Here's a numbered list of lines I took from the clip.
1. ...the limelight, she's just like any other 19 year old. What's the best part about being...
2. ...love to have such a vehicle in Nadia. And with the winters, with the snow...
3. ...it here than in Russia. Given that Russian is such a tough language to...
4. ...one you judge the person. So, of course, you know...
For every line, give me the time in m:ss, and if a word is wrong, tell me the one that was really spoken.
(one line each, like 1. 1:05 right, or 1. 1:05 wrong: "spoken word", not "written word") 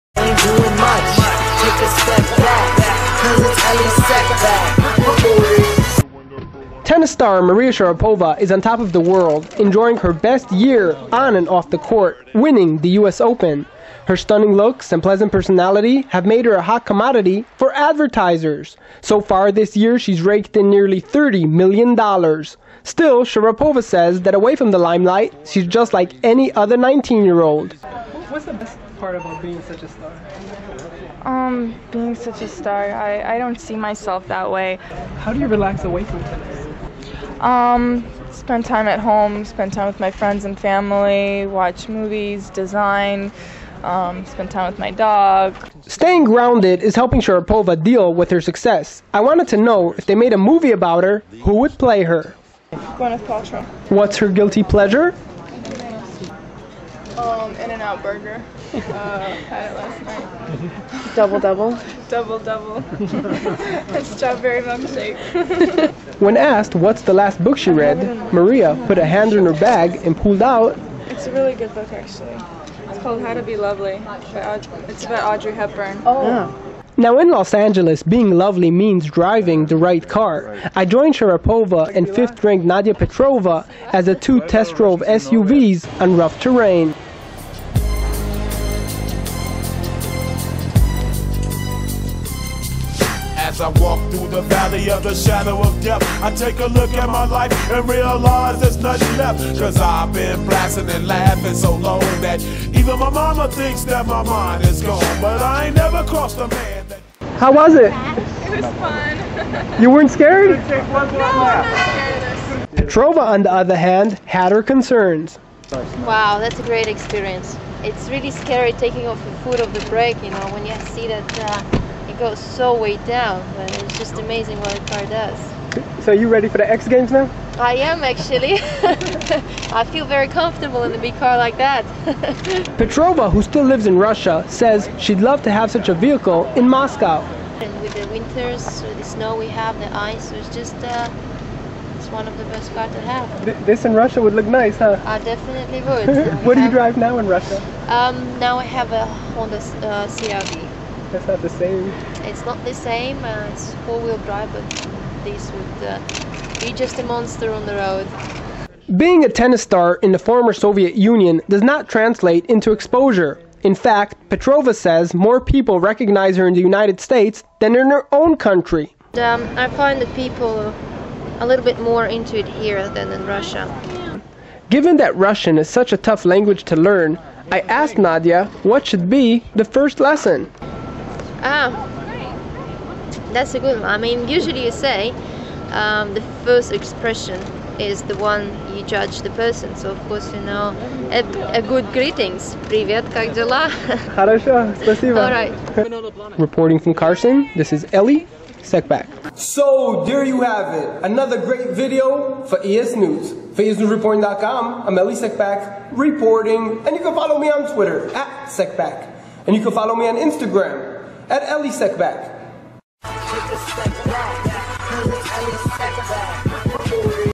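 1. 0:24 right
2. 2:15 wrong: "Moscow", not "Nadia"
3. 2:52 right
4. 3:08 right.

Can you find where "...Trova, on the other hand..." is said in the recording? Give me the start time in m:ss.
1:52.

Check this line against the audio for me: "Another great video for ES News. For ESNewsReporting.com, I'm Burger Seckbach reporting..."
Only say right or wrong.
wrong.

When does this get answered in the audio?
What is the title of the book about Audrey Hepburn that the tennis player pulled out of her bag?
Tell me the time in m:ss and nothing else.
1:13.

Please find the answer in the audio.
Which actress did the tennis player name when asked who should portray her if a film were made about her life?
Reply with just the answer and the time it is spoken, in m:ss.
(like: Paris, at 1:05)
Gwyneth Paltrow, at 0:52.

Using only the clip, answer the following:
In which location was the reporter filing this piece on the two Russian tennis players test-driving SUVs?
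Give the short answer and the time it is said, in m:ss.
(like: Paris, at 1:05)
Carson, at 3:16.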